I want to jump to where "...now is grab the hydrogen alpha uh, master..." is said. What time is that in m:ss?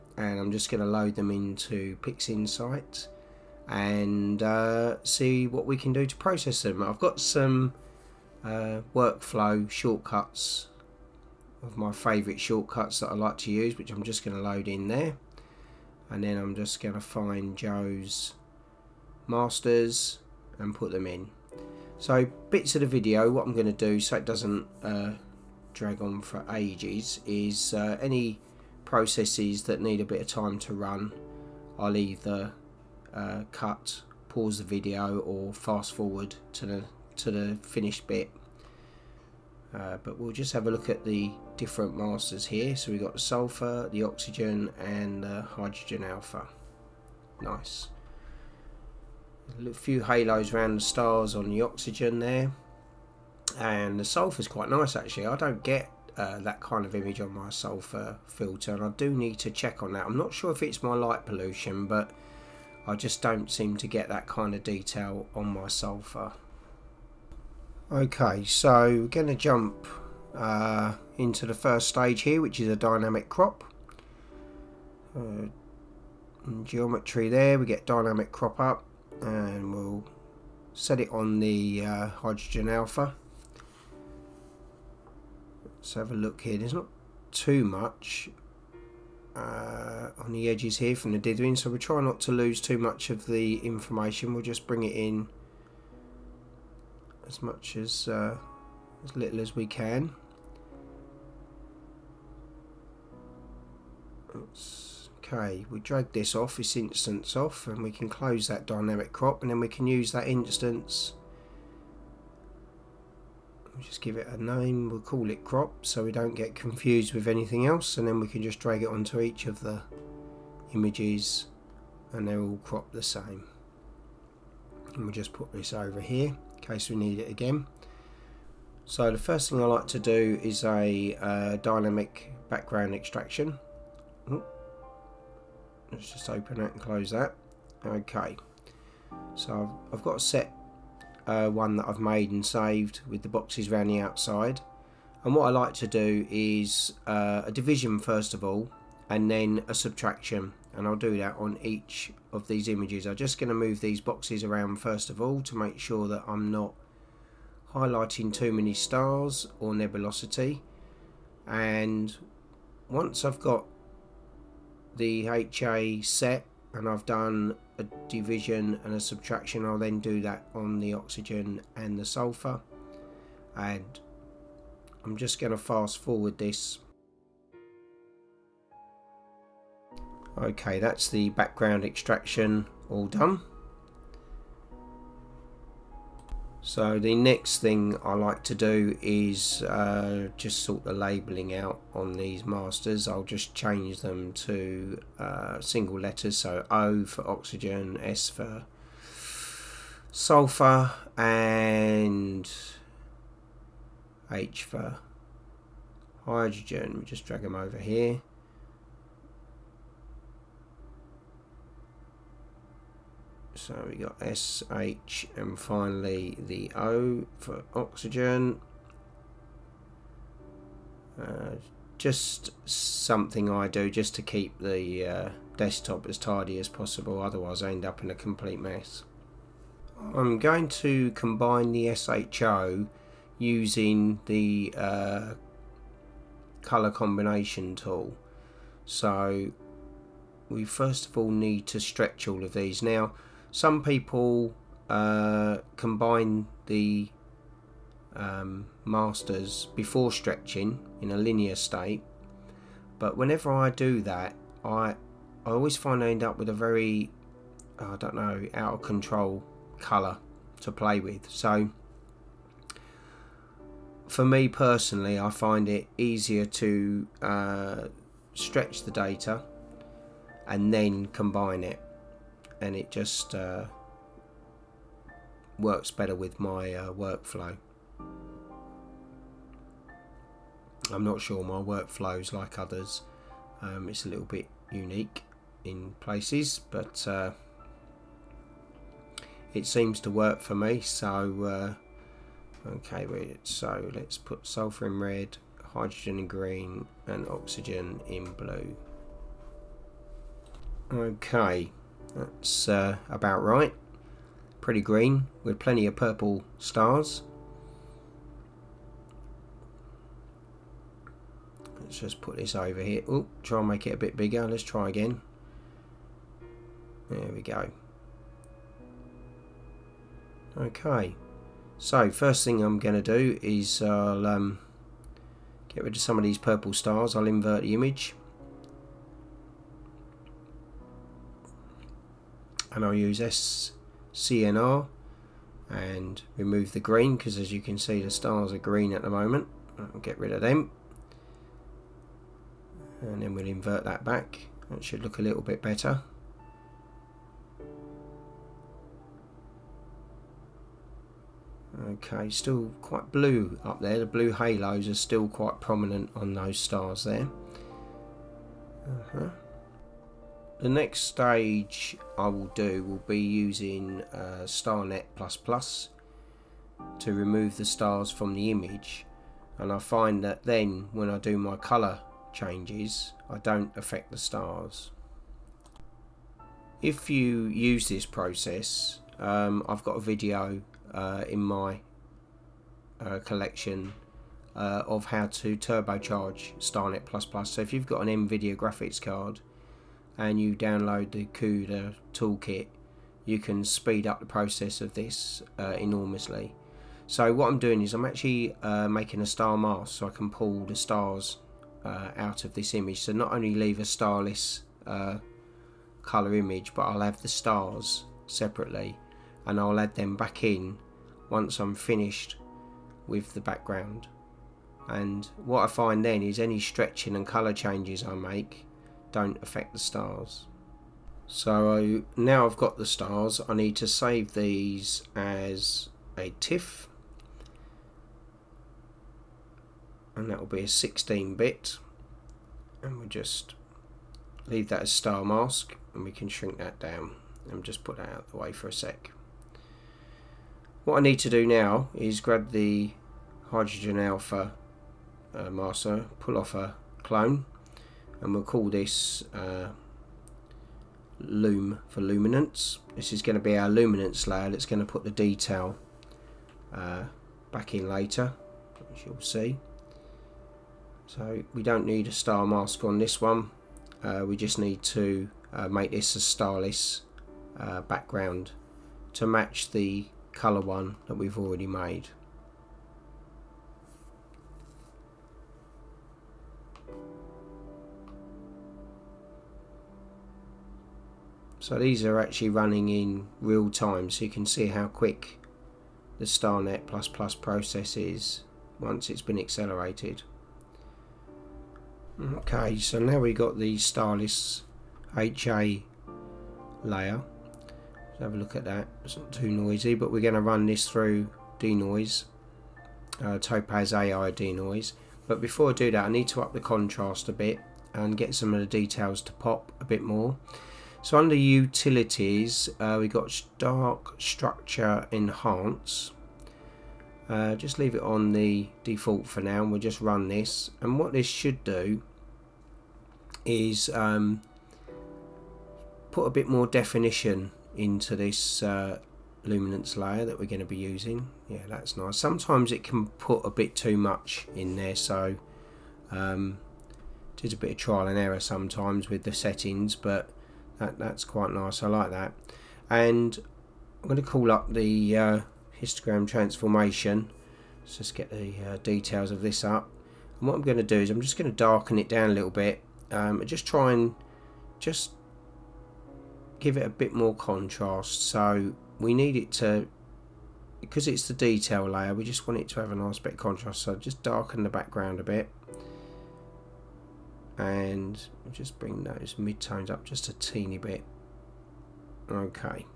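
7:21.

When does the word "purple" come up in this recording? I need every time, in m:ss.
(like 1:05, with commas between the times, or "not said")
5:05, 5:26.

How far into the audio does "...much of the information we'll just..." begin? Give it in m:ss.
1:32.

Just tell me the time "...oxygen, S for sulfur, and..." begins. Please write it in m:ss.
3:17.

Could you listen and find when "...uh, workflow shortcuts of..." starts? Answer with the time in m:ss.
0:08.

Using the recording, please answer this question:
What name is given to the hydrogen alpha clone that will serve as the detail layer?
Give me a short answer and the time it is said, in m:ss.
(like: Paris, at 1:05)
loom, at 7:31.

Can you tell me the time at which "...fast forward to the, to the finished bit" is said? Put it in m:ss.
0:35.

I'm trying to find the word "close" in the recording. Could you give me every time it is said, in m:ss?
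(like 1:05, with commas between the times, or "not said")
1:48, 2:16.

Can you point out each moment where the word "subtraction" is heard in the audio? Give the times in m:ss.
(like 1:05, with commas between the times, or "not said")
2:29, 2:48.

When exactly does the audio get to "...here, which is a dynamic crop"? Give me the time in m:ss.
1:12.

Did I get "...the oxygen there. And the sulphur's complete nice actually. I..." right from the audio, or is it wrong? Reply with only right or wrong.
wrong.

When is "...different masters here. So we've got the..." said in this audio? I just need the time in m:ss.
0:41.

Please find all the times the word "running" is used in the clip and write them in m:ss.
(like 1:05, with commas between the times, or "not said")
8:02.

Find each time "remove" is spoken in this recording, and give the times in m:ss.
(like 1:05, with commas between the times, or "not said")
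5:36, 6:07.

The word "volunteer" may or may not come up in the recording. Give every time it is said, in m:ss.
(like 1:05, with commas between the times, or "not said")
not said.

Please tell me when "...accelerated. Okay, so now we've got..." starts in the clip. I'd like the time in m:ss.
8:09.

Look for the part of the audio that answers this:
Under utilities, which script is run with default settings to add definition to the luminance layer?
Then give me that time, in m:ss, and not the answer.
8:33.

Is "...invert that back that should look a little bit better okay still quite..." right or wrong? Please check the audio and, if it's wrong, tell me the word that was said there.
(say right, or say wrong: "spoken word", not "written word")
right.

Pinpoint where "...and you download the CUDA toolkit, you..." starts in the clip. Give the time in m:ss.
6:30.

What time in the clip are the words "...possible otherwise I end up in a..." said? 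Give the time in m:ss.
3:46.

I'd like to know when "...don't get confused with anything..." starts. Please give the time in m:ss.
1:56.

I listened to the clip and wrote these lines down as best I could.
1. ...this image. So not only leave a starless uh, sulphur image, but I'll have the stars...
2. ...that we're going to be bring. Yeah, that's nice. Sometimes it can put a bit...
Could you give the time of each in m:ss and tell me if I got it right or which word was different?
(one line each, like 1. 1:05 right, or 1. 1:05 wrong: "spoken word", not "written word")
1. 6:42 wrong: "colour", not "sulphur"
2. 8:50 wrong: "using", not "bring".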